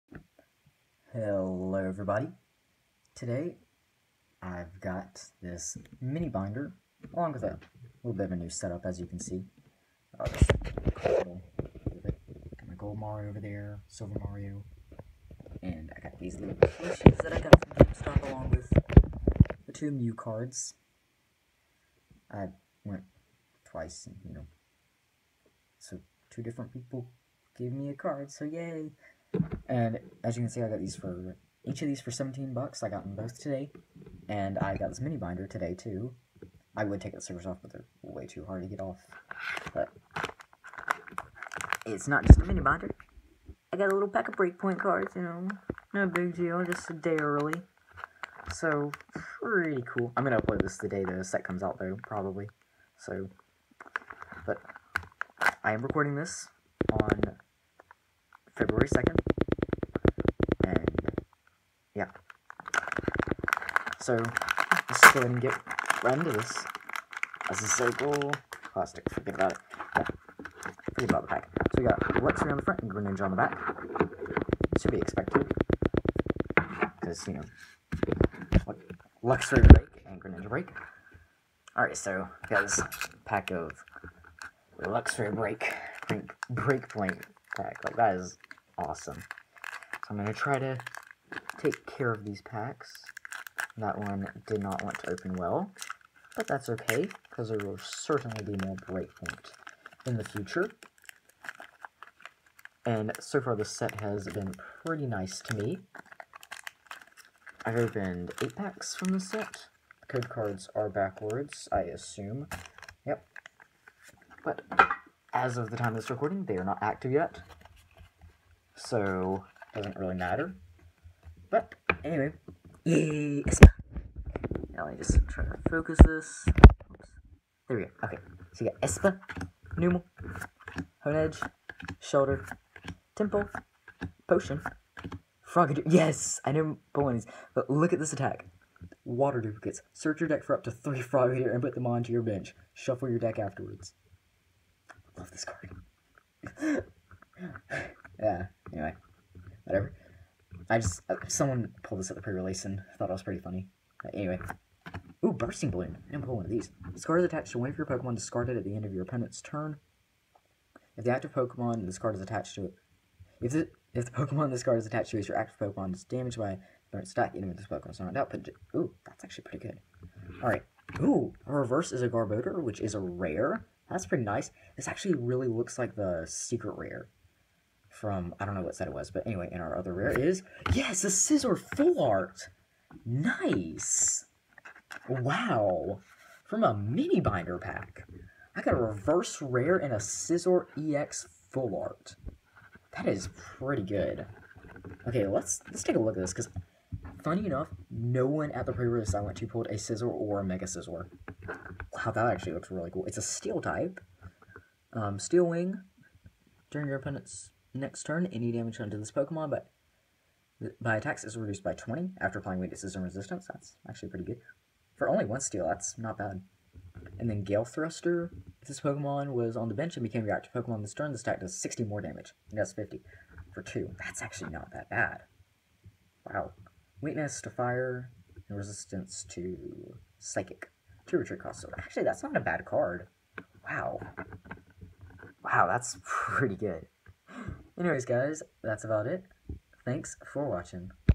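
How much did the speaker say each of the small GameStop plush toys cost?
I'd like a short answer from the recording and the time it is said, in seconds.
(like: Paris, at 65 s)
$17, at 32 s.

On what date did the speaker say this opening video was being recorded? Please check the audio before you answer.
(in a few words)
February 2nd.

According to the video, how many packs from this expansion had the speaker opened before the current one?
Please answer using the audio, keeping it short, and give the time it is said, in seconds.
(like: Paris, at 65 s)
8, at 108 s.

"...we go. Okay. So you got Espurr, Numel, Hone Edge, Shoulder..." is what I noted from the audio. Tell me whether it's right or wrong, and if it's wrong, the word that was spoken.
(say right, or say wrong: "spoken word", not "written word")
right.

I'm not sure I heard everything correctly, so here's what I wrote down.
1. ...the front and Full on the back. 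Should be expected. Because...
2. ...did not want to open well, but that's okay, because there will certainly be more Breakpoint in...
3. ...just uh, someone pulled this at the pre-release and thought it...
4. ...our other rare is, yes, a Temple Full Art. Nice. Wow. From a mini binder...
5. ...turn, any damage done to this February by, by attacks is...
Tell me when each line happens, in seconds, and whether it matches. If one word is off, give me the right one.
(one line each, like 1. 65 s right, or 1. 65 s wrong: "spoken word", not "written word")
1. 72 s wrong: "Greninja", not "Full"
2. 94 s right
3. 150 s right
4. 179 s wrong: "Scizor", not "Temple"
5. 208 s wrong: "Pokemon", not "February".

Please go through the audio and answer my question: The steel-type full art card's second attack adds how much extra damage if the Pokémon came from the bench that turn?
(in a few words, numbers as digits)
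60.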